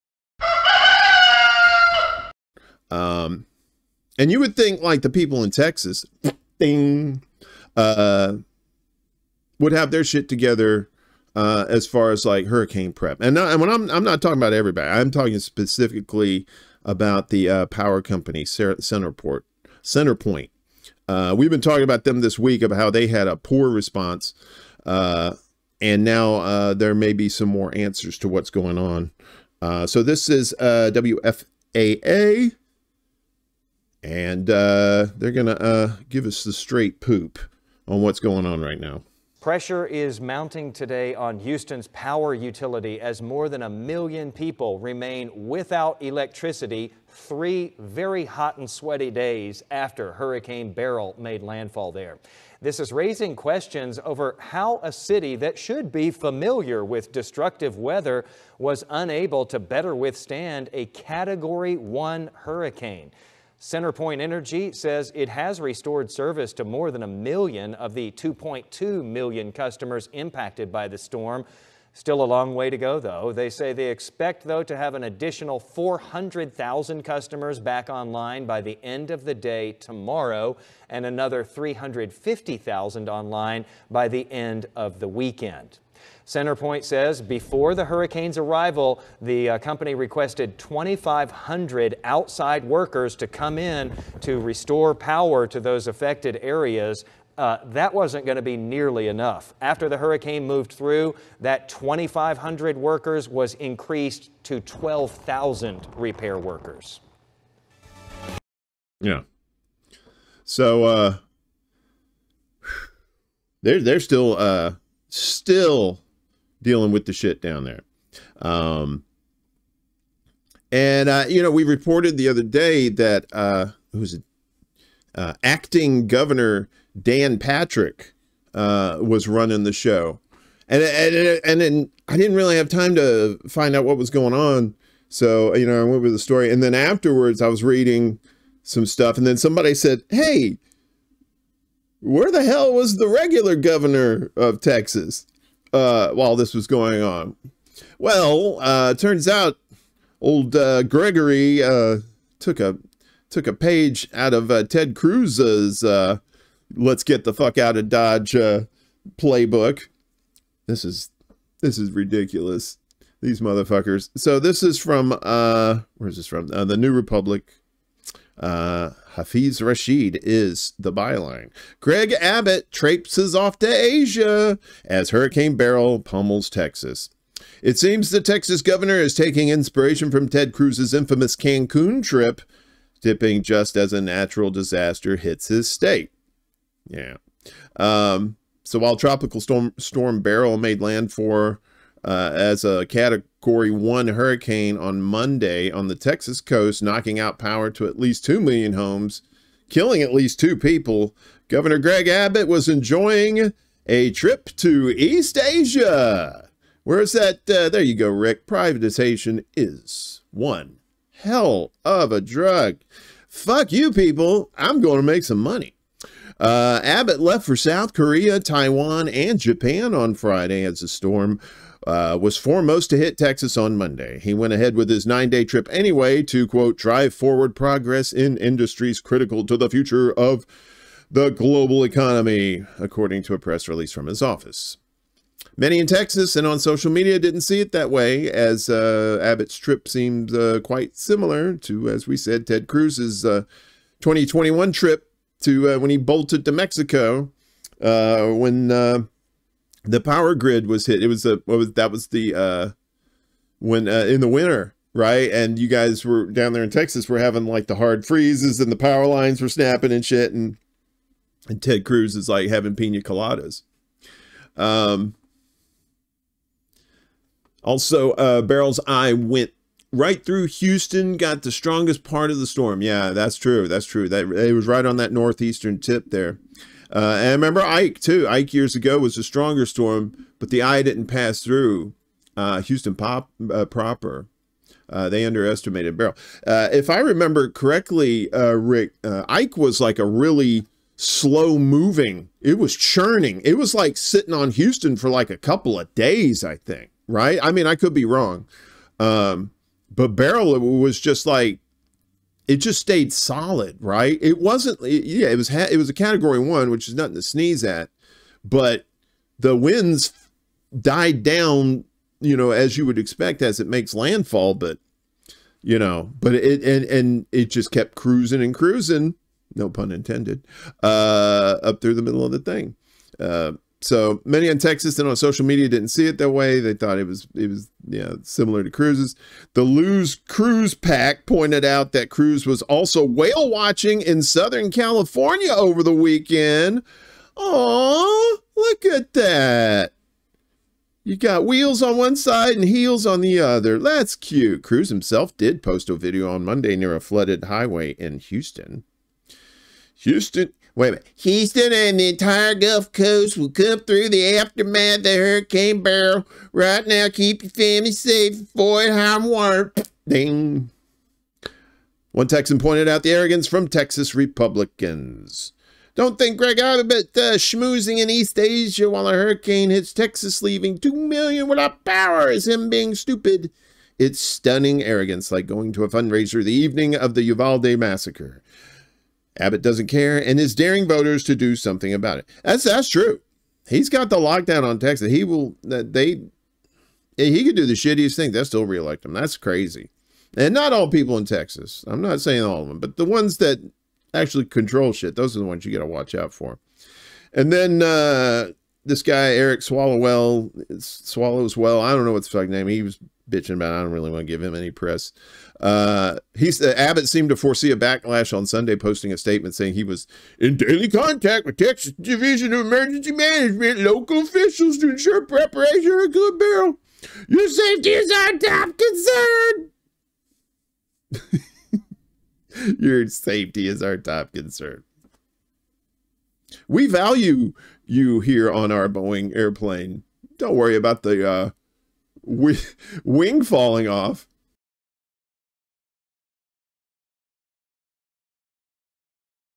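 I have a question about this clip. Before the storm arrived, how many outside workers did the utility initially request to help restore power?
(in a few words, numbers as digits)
2,500.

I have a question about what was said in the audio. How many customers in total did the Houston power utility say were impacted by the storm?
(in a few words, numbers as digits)
2.2 million.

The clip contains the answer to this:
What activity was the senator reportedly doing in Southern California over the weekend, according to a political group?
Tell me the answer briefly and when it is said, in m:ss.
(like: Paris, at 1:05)
Whale watching, at 5:33.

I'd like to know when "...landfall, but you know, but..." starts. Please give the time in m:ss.
5:13.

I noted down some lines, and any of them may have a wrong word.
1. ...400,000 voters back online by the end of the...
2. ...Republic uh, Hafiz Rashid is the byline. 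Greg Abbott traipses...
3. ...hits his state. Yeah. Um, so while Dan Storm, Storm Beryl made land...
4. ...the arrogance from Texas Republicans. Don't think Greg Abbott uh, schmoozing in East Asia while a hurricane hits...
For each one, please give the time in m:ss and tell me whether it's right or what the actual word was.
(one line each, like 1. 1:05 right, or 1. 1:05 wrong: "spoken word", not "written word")
1. 1:15 wrong: "customers", not "voters"
2. 2:46 right
3. 3:05 wrong: "Tropical", not "Dan"
4. 6:03 right.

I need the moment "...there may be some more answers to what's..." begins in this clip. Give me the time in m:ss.
0:26.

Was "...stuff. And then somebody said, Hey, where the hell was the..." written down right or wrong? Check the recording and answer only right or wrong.
right.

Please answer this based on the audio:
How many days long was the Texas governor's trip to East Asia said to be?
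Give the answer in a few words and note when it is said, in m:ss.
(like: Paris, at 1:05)
9, at 3:45.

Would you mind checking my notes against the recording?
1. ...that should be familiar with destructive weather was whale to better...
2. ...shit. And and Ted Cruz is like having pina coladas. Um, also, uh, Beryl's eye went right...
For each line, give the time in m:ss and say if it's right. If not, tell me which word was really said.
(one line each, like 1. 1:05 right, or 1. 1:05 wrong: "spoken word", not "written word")
1. 0:55 wrong: "unable", not "whale"
2. 4:20 right.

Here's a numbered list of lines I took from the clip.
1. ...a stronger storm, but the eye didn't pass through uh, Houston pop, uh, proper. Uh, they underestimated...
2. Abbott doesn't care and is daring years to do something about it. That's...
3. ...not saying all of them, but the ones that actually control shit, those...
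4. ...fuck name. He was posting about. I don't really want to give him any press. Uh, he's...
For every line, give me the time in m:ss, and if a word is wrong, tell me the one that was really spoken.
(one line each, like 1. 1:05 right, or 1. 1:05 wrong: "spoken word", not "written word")
1. 4:39 right
2. 6:19 wrong: "voters", not "years"
3. 6:32 right
4. 6:42 wrong: "bitching", not "posting".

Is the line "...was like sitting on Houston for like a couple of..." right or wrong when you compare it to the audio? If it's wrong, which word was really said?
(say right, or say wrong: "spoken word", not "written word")
right.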